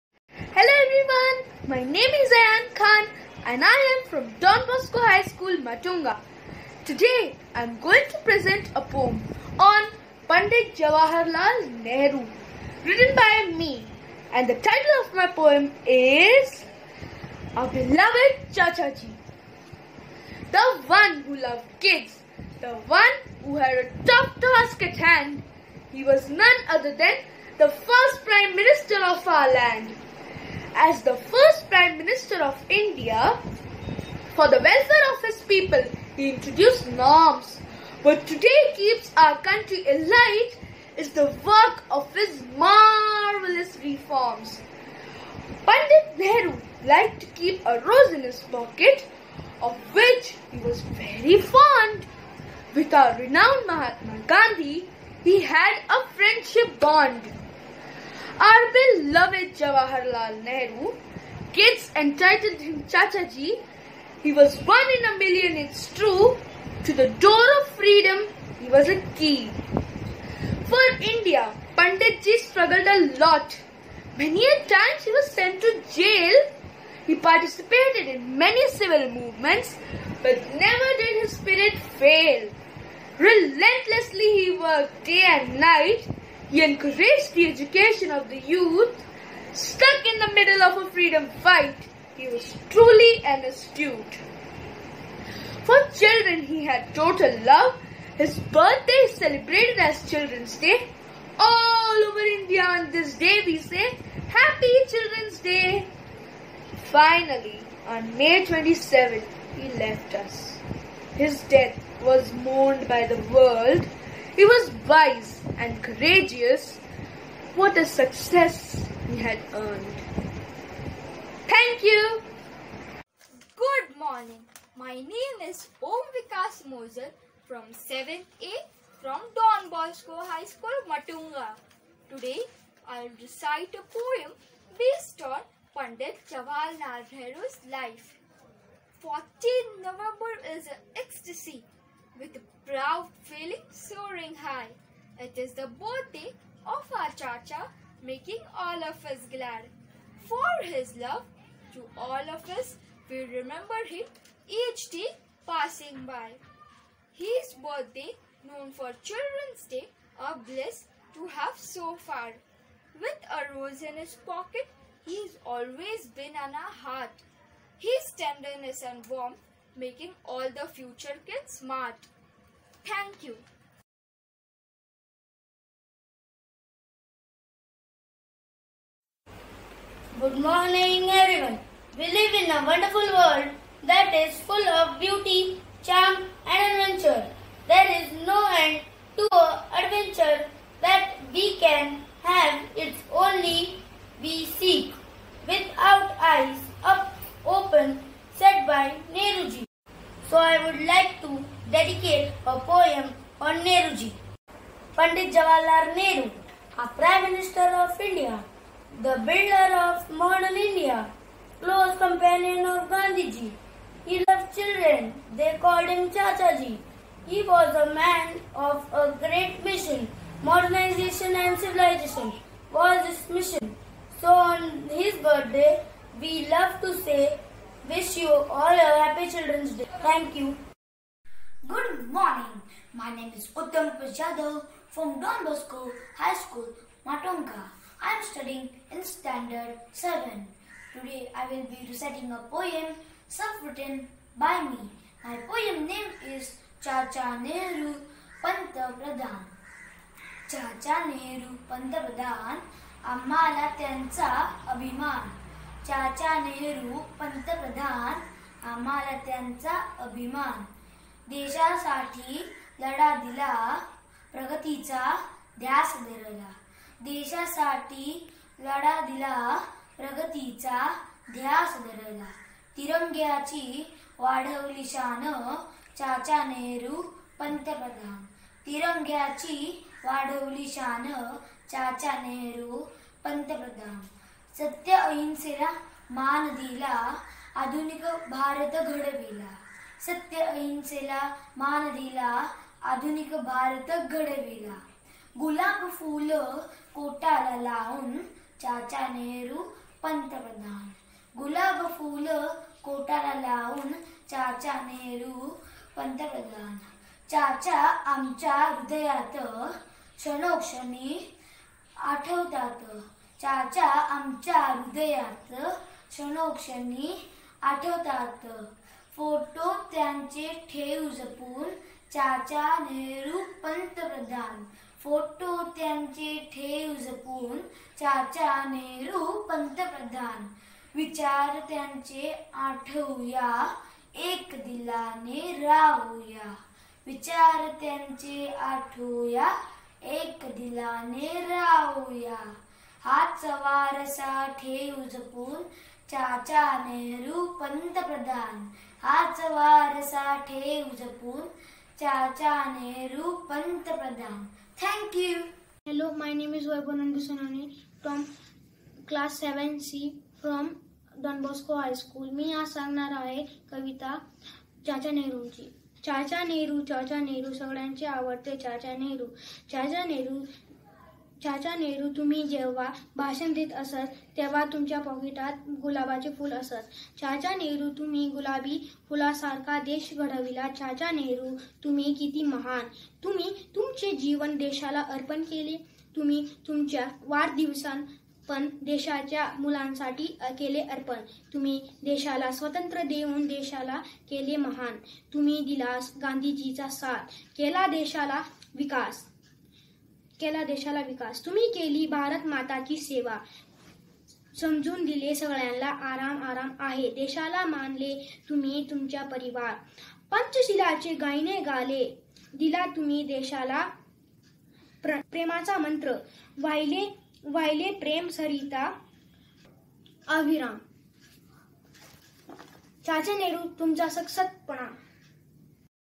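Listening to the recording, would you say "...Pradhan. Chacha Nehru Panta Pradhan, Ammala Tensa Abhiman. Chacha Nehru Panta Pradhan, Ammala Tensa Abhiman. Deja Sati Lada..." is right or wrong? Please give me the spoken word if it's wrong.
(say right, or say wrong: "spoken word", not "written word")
right.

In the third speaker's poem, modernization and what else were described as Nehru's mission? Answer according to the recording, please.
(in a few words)
civilization.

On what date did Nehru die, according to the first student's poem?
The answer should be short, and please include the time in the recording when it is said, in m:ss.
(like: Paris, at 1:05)
May 27, at 1:48.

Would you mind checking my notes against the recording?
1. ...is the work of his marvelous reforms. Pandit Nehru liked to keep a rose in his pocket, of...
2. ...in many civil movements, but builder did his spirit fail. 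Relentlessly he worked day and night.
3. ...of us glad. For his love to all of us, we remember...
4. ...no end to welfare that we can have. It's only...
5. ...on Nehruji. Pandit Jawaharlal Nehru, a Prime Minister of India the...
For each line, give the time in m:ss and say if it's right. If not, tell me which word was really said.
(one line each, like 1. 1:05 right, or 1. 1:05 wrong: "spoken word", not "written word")
1. 0:40 right
2. 1:18 wrong: "never", not "builder"
3. 2:28 right
4. 3:08 wrong: "adventure", not "welfare"
5. 3:23 right.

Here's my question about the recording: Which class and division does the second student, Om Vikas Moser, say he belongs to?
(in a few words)
7A.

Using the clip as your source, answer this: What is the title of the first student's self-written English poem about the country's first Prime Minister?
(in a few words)
Our Beloved Chacha Ji.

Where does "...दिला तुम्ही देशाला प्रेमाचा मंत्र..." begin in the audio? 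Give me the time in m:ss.
6:52.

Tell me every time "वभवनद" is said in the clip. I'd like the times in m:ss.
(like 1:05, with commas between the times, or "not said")
5:56.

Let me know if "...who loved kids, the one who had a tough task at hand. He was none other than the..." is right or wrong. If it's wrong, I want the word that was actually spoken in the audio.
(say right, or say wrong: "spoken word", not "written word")
right.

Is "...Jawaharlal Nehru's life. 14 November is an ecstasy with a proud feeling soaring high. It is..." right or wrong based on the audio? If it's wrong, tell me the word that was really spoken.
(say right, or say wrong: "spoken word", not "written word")
right.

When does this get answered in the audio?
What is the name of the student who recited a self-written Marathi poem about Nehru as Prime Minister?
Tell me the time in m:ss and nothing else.
3:53.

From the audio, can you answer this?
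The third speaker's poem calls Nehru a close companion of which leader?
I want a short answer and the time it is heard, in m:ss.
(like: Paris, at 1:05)
Gandhiji, at 3:32.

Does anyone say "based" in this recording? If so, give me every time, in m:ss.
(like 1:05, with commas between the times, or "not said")
2:14.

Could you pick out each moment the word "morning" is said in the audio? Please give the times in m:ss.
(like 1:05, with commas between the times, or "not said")
2:03, 3:00, 3:52.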